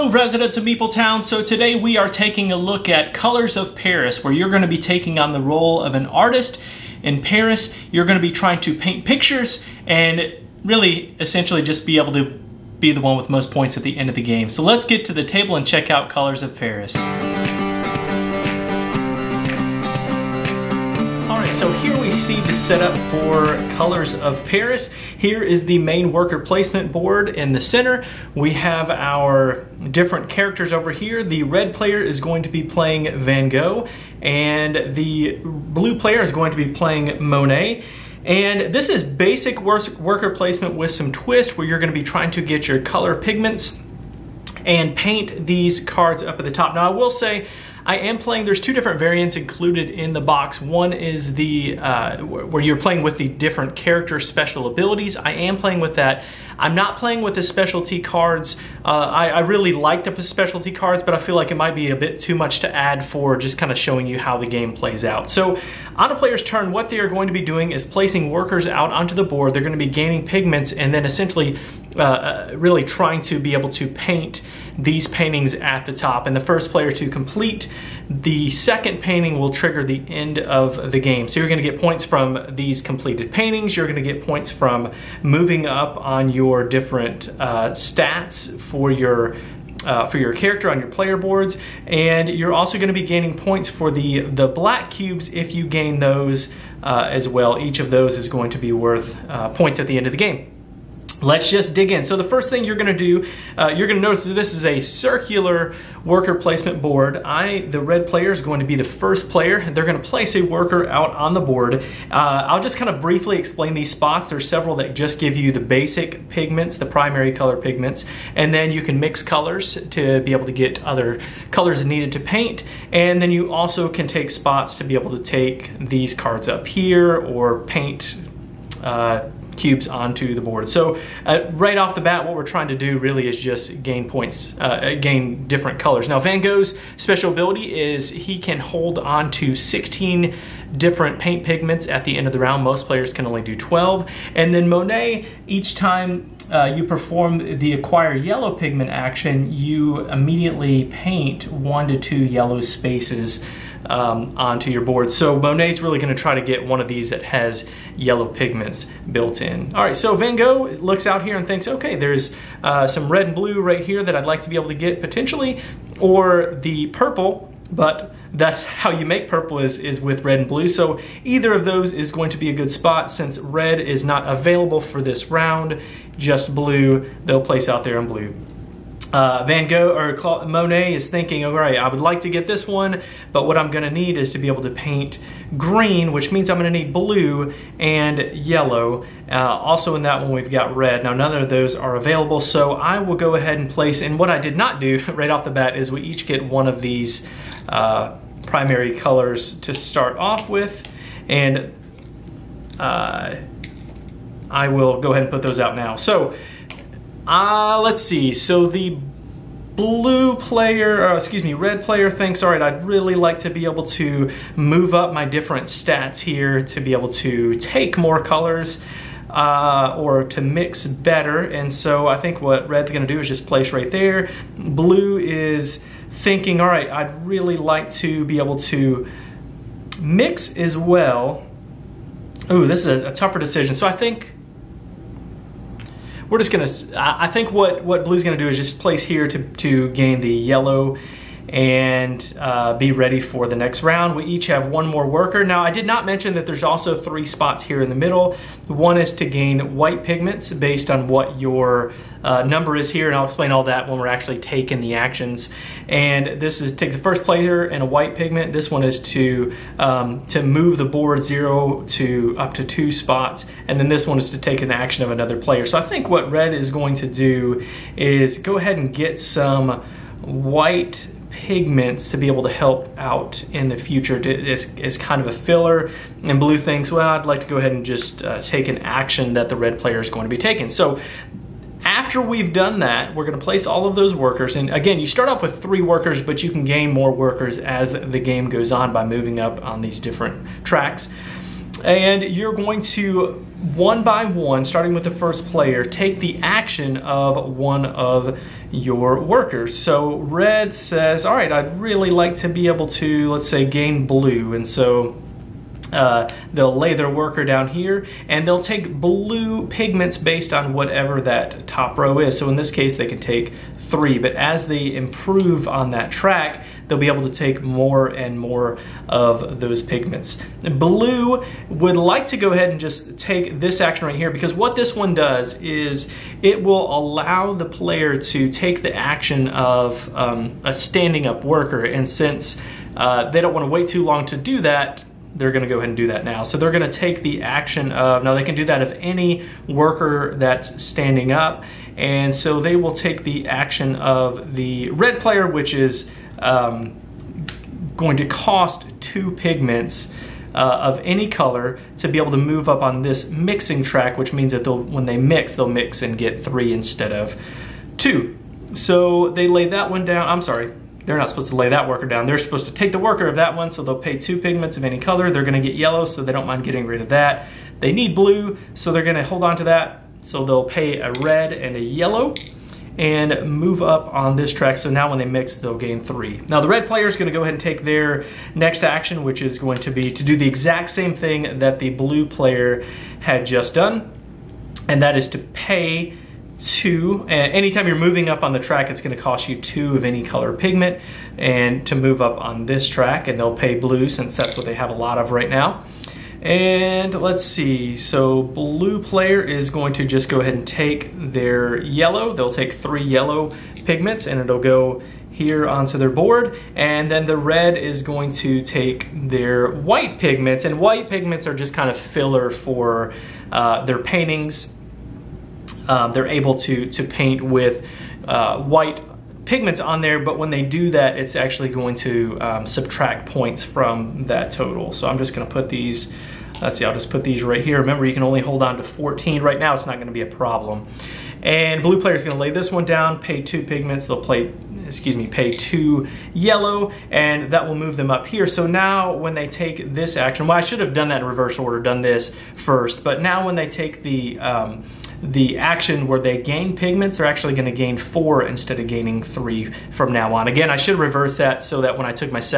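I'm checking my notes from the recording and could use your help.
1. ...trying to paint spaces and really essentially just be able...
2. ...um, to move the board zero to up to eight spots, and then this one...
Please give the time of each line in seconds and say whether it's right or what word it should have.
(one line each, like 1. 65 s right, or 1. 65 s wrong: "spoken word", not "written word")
1. 8 s wrong: "pictures", not "spaces"
2. 259 s wrong: "two", not "eight".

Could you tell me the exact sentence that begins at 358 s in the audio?
So they laid that one down, I'm sorry, they're not supposed to lay that worker down.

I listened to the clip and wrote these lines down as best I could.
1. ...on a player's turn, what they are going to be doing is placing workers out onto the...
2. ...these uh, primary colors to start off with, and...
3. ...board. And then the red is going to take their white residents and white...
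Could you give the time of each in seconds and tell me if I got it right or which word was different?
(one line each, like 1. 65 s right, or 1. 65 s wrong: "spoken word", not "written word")
1. 65 s right
2. 196 s right
3. 406 s wrong: "pigments", not "residents".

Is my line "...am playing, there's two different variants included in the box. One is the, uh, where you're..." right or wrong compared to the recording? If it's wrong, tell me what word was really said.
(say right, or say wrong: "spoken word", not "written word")
right.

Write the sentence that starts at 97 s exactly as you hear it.
Each of those is going to be worth uh, points at the end of the game.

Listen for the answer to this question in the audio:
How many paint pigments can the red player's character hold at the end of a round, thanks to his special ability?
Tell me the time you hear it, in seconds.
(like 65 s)
139 s.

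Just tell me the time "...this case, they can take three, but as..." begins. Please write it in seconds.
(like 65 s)
312 s.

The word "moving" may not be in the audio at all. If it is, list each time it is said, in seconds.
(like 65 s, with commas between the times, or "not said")
85 s, 289 s, 387 s.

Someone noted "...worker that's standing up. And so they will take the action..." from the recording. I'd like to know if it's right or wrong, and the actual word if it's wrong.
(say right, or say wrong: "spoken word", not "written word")
right.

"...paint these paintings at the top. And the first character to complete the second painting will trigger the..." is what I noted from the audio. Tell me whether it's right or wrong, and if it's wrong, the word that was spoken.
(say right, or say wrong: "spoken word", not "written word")
wrong: "player", not "character".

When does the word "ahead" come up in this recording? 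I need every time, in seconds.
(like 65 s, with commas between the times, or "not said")
193 s, 205 s, 268 s, 277 s, 322 s, 335 s, 377 s, 400 s.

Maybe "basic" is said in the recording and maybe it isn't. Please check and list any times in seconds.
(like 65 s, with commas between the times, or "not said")
39 s, 115 s.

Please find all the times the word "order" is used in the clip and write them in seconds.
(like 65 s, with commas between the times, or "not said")
441 s.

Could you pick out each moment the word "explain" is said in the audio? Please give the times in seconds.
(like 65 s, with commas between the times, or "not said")
113 s, 253 s.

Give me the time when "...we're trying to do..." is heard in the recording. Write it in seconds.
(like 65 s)
132 s.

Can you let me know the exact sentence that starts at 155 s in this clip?
So Monet's really gonna try to get one of these that has yellow pigments built in.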